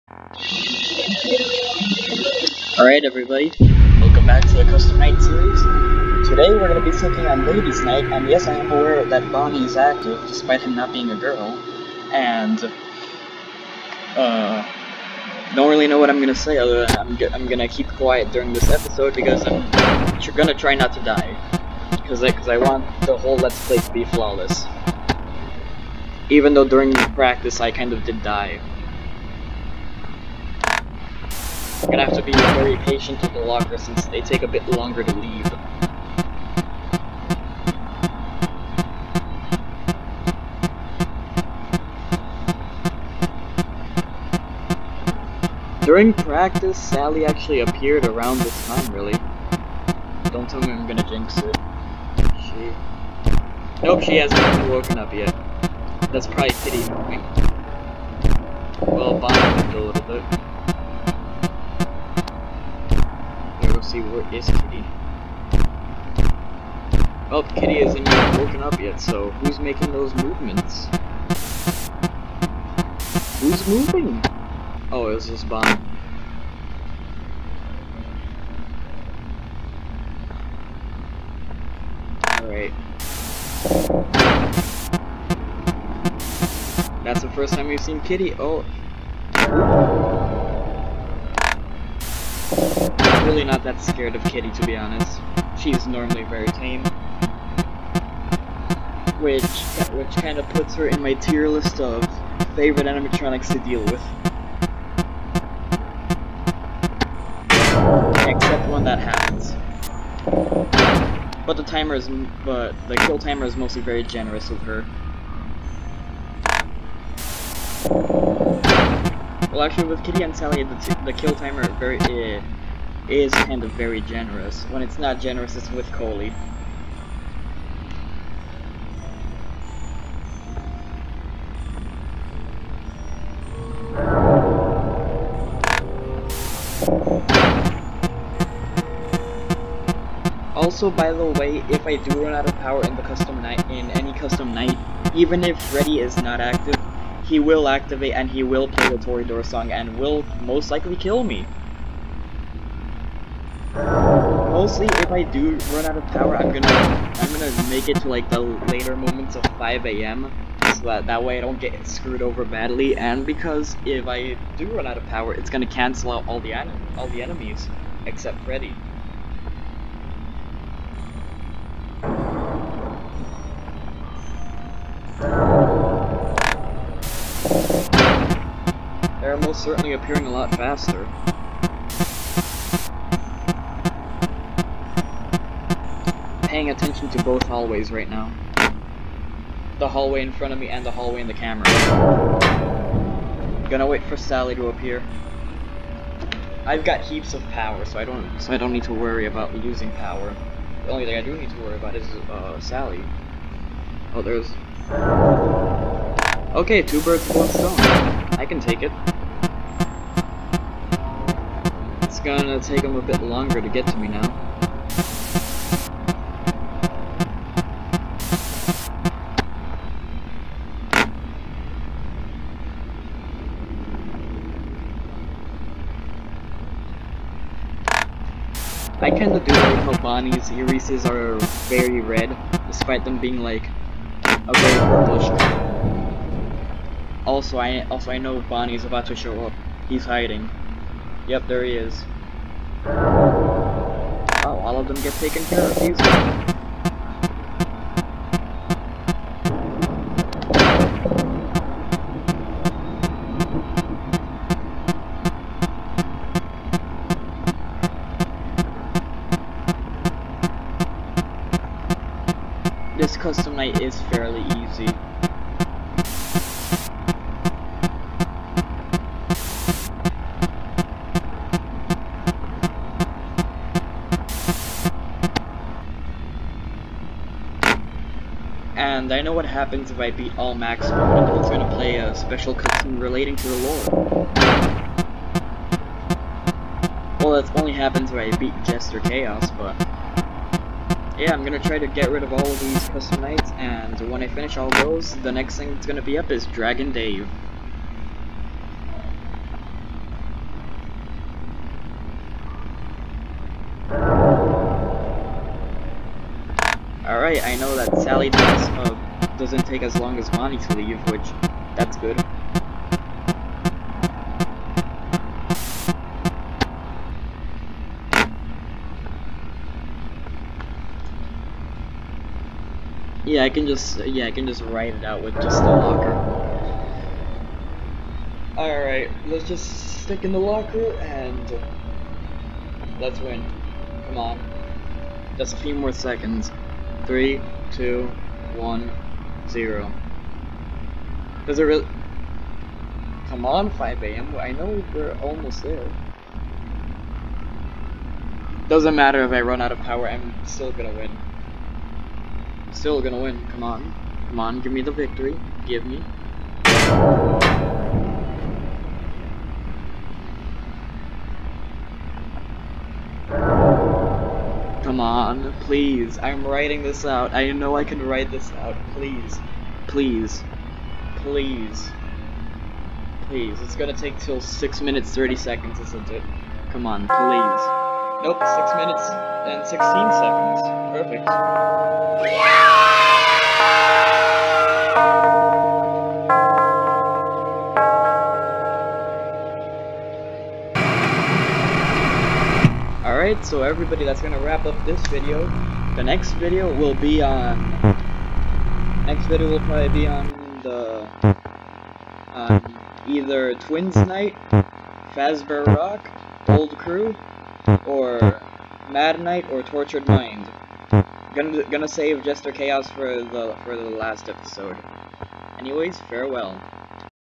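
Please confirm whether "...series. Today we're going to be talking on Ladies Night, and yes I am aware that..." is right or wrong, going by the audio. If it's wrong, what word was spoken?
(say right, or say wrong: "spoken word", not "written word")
right.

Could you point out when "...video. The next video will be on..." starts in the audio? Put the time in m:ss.
6:35.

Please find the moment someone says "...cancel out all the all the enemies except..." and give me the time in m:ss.
2:45.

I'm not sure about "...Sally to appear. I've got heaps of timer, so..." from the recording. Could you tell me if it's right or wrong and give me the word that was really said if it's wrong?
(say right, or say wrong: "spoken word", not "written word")
wrong: "power", not "timer".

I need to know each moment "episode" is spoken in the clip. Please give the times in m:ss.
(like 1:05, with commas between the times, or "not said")
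0:18, 6:54.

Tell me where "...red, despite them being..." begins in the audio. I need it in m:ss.
3:52.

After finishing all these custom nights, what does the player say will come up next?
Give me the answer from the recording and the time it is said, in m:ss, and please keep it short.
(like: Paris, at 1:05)
Dragon Dave, at 4:56.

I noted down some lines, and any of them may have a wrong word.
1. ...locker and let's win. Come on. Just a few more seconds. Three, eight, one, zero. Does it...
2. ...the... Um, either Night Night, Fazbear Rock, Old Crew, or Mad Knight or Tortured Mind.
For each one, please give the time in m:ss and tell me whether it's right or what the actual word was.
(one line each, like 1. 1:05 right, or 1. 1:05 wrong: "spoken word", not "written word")
1. 5:30 wrong: "two", not "eight"
2. 6:40 wrong: "Twins", not "Night".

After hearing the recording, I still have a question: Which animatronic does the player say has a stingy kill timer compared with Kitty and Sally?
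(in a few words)
Coley.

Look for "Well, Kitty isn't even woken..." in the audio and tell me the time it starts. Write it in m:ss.
1:07.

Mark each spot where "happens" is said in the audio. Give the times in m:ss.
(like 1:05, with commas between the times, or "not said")
1:48, 4:39, 4:47.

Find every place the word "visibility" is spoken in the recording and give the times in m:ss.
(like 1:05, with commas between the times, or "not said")
not said.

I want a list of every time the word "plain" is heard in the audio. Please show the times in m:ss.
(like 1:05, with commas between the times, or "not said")
not said.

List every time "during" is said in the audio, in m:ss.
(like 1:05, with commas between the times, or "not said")
0:18, 0:26, 0:45.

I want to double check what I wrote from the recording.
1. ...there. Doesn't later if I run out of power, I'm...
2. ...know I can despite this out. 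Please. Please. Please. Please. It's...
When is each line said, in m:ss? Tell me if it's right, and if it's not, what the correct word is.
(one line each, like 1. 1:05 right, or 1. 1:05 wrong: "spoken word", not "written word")
1. 5:45 wrong: "matter", not "later"
2. 6:07 wrong: "write", not "despite".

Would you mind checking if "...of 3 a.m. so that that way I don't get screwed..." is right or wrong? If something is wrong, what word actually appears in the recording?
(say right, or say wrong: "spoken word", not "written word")
wrong: "5", not "3".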